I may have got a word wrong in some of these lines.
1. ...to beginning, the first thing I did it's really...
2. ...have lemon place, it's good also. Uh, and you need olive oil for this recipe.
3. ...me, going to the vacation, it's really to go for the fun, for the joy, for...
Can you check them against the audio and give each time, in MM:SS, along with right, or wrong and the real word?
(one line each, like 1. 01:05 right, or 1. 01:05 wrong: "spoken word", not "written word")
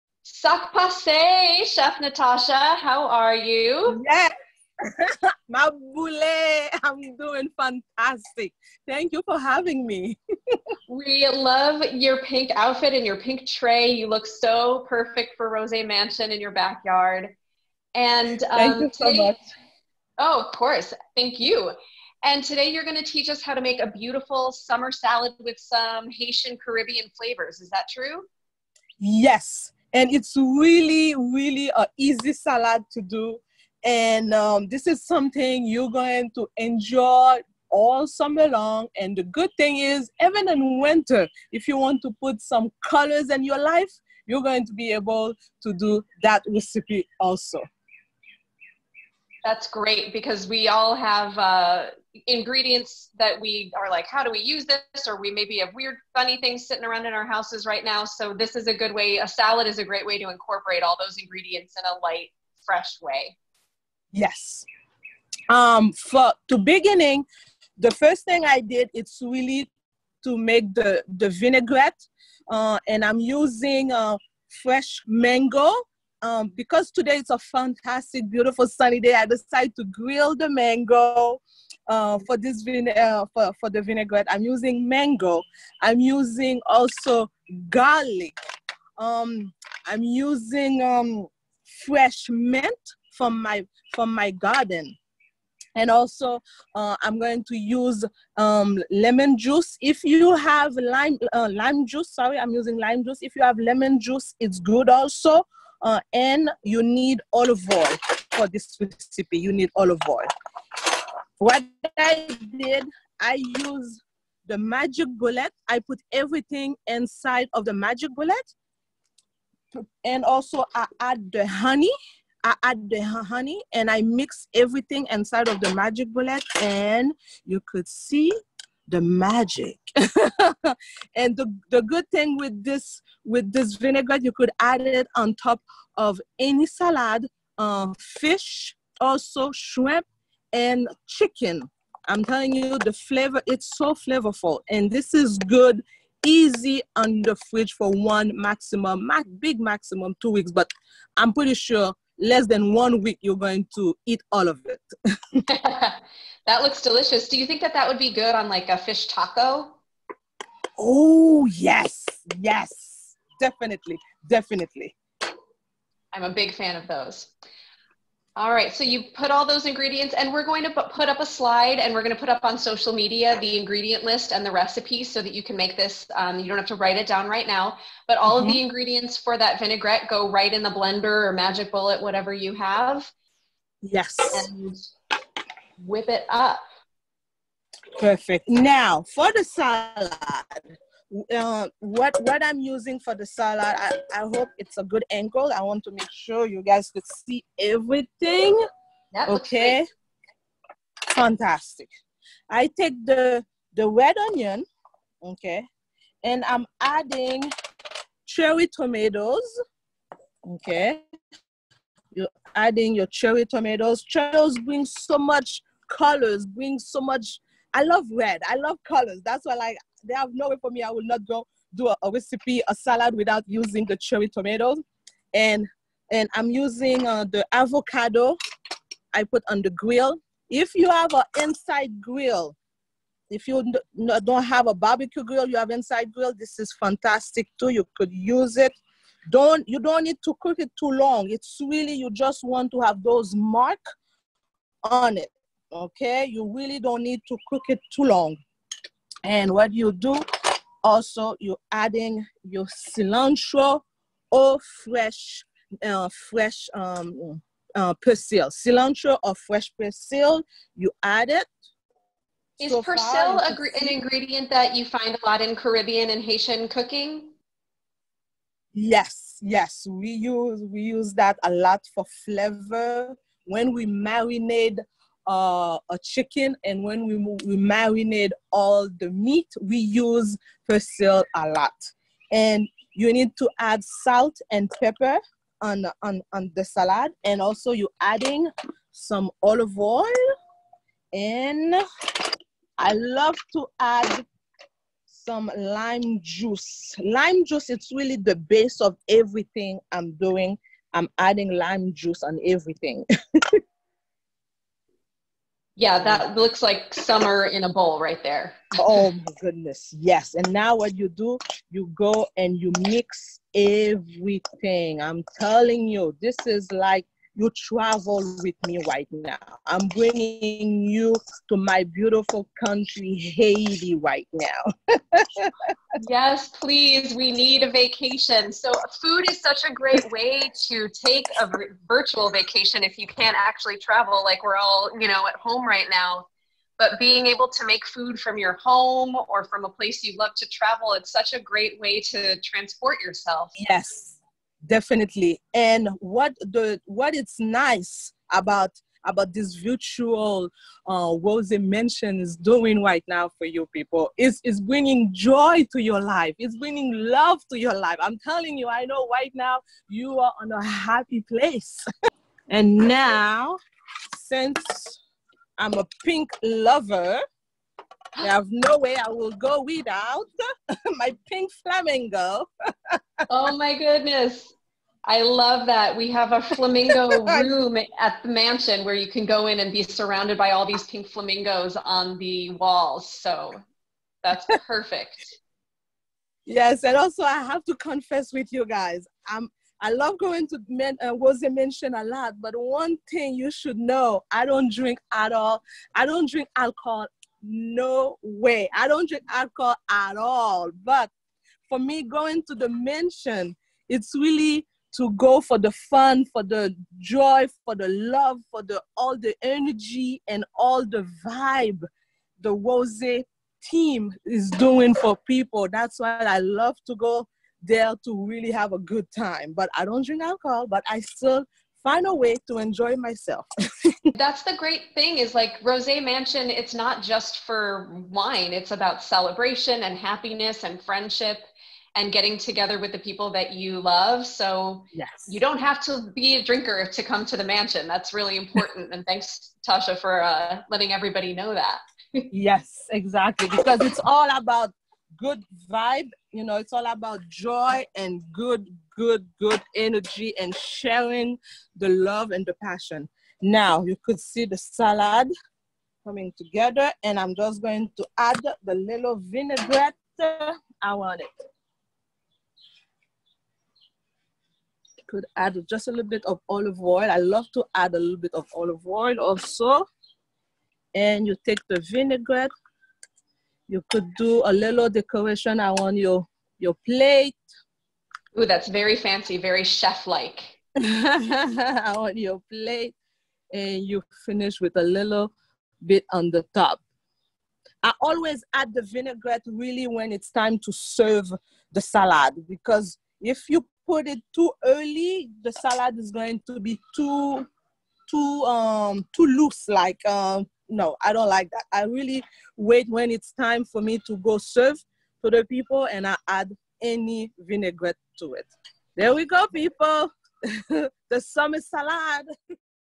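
1. 01:06 right
2. 01:43 wrong: "juice", not "place"
3. 06:41 wrong: "mansion", not "vacation".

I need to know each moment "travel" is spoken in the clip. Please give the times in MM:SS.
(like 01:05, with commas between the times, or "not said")
05:17, 05:33, 05:40.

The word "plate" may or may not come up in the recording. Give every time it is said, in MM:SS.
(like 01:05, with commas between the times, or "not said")
07:56, 08:02.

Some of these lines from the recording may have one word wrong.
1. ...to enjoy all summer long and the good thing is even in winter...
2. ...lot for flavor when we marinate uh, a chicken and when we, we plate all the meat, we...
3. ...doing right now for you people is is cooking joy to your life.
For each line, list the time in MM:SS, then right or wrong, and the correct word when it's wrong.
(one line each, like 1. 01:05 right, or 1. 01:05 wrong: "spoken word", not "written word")
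1. 00:36 right
2. 04:31 wrong: "marinate", not "plate"
3. 05:52 wrong: "bringing", not "cooking".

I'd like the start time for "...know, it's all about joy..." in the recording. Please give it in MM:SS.
07:26.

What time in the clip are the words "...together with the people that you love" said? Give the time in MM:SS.
07:12.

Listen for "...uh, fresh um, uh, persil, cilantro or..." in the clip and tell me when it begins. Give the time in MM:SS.
04:15.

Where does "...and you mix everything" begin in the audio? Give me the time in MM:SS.
05:12.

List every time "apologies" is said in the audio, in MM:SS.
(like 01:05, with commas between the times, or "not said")
not said.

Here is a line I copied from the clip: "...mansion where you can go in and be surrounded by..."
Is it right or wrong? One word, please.
right.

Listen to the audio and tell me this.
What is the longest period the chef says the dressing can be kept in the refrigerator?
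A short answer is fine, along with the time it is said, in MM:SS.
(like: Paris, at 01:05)
2 weeks, at 02:30.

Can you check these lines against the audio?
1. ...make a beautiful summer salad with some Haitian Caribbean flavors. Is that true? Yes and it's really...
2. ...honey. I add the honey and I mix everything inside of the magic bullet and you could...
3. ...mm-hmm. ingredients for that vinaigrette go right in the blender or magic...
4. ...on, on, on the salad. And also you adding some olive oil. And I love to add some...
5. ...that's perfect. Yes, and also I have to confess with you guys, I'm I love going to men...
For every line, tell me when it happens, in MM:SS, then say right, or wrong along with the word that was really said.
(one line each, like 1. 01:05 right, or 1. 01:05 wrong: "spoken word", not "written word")
1. 00:23 right
2. 02:01 right
3. 02:58 right
4. 04:45 right
5. 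06:24 right.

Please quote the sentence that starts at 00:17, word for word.
And um, thank you so today, much.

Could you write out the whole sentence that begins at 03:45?
And, and I'm using uh, the avocado I put on the grill.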